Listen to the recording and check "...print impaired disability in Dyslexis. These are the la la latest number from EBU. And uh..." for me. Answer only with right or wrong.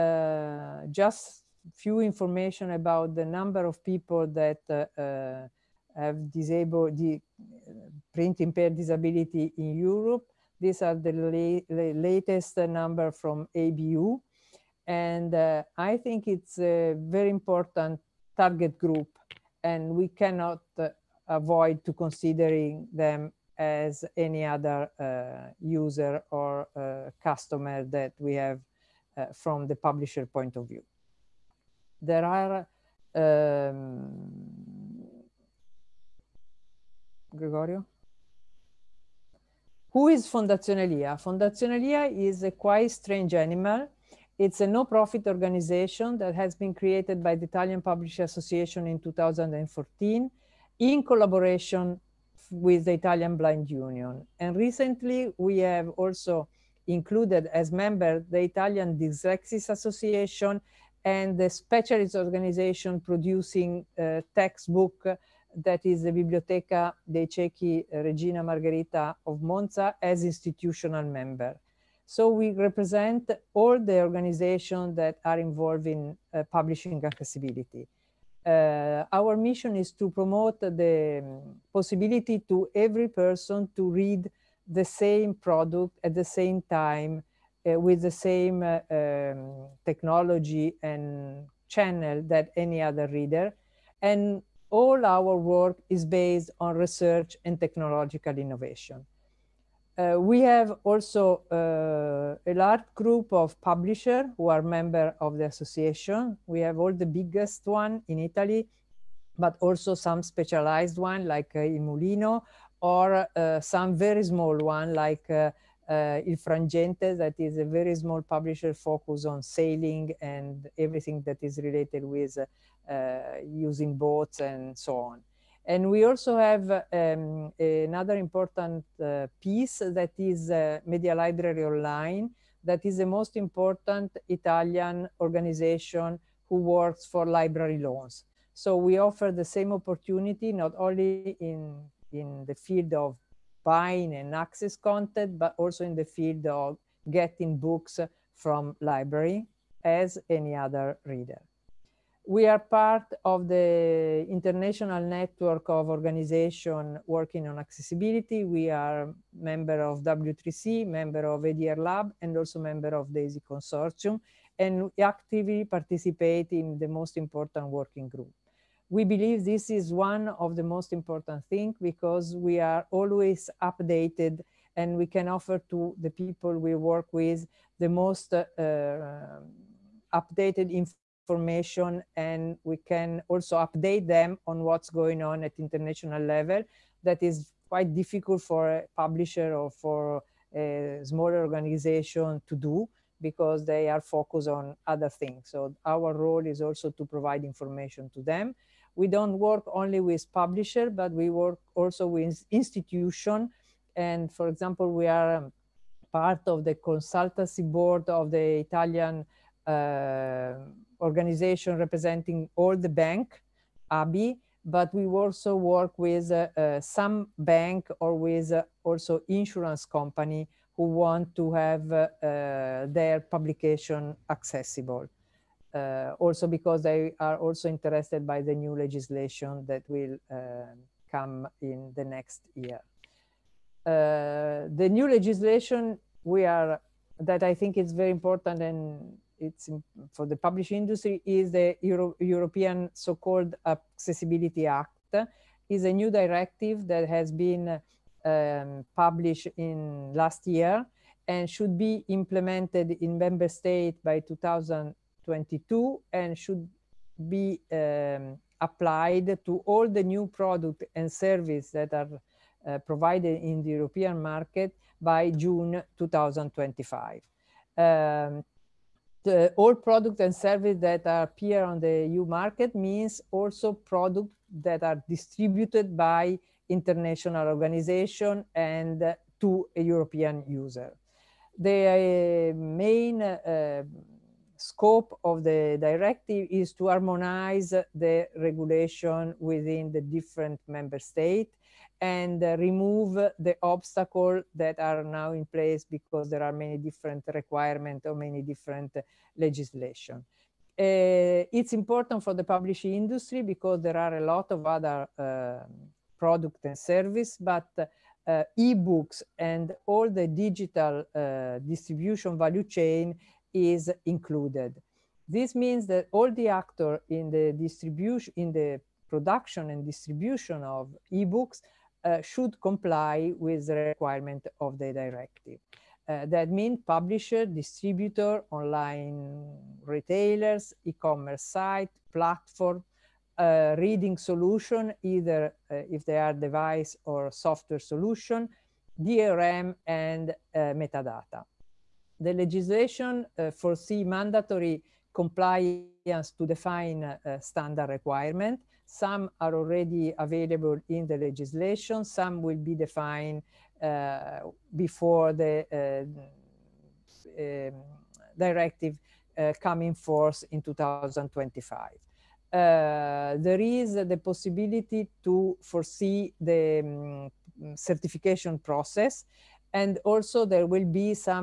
wrong.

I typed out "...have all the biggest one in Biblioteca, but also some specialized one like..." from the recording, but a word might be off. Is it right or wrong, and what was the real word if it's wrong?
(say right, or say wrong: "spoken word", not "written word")
wrong: "Italy", not "Biblioteca".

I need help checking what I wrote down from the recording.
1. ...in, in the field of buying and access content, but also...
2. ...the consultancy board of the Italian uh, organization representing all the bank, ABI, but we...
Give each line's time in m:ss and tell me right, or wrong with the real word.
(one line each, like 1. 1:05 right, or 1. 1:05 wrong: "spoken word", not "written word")
1. 2:21 right
2. 3:26 right.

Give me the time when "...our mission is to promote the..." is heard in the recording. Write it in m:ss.
1:19.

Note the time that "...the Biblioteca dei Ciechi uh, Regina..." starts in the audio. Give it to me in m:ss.
1:06.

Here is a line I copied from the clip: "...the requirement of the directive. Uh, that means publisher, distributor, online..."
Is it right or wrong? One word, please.
right.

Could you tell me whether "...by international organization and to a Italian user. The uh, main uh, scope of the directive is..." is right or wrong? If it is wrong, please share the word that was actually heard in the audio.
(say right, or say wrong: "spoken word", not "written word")
wrong: "European", not "Italian".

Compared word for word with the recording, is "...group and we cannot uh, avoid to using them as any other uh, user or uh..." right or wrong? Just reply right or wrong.
wrong.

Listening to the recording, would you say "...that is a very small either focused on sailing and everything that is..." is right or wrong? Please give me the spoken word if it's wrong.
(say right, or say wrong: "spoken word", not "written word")
wrong: "publisher", not "either".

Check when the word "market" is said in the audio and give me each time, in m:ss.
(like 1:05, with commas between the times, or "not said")
4:24, 4:32.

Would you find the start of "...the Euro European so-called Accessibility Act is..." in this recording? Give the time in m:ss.
4:01.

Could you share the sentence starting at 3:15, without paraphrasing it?
So our role is also to provide information to them.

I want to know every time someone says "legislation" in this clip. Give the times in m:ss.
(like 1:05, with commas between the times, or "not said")
3:48, 3:55, 4:59, 5:42, 5:51.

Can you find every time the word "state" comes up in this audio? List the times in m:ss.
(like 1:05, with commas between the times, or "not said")
4:13, 4:50.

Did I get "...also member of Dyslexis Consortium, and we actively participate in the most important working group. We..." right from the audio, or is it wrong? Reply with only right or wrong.
wrong.